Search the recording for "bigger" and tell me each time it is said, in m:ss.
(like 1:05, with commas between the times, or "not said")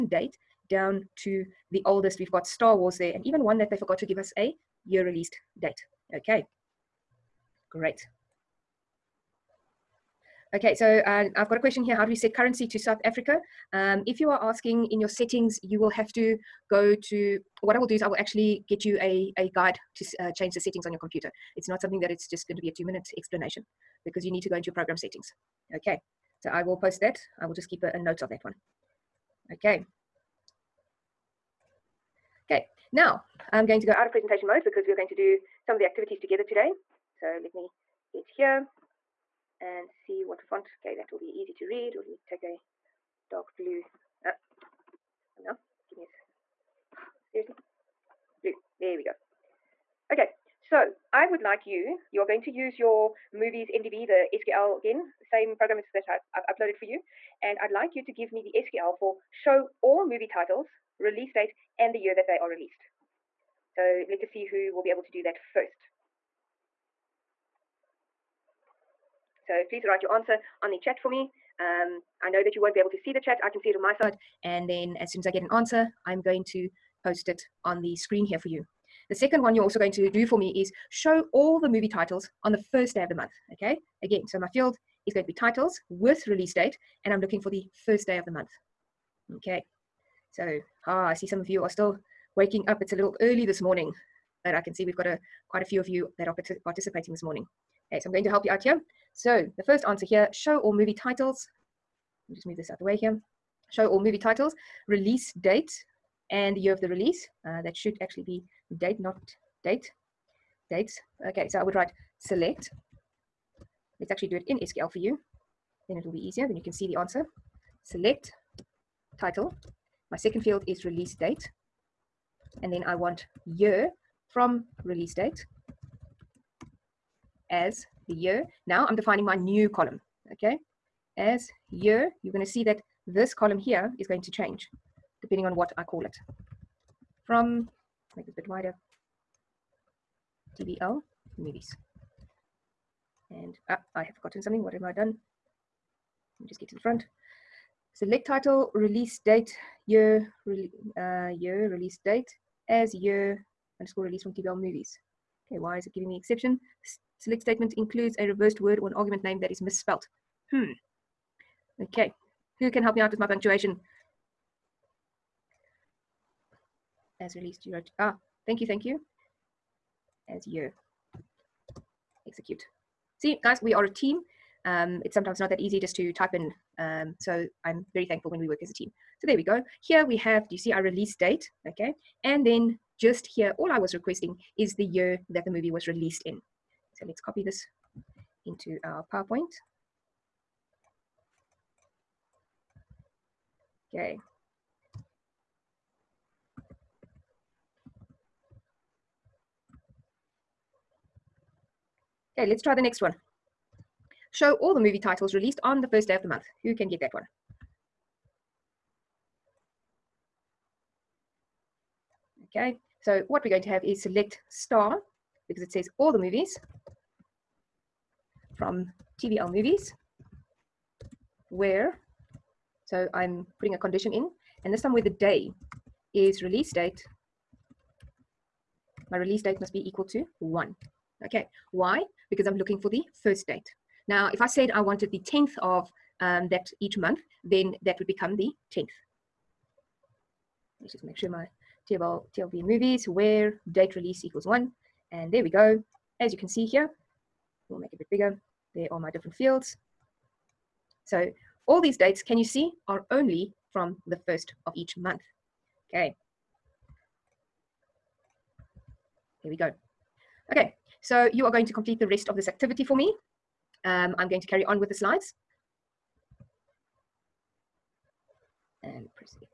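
4:08.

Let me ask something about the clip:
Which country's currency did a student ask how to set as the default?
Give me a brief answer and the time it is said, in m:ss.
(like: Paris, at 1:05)
South Africa, at 0:12.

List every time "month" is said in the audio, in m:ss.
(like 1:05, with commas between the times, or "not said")
1:23, 1:28, 3:26, 3:56, 4:14.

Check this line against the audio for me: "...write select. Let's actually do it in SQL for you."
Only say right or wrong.
right.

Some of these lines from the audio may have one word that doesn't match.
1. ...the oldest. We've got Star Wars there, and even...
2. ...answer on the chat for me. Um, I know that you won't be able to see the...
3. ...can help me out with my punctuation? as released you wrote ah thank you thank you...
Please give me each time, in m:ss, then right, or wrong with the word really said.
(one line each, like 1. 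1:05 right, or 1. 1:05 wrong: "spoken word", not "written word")
1. 0:01 right
2. 1:10 right
3. 2:42 right.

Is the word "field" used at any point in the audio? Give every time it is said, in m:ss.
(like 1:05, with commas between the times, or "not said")
1:24, 2:00, 4:09.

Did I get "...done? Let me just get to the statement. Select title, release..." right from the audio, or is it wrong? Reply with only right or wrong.
wrong.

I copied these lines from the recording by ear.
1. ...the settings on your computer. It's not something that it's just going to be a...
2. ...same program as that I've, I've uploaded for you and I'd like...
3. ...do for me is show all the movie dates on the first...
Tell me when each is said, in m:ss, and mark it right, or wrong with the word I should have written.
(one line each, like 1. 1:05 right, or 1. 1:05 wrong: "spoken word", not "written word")
1. 0:20 right
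2. 0:55 right
3. 1:20 wrong: "titles", not "dates".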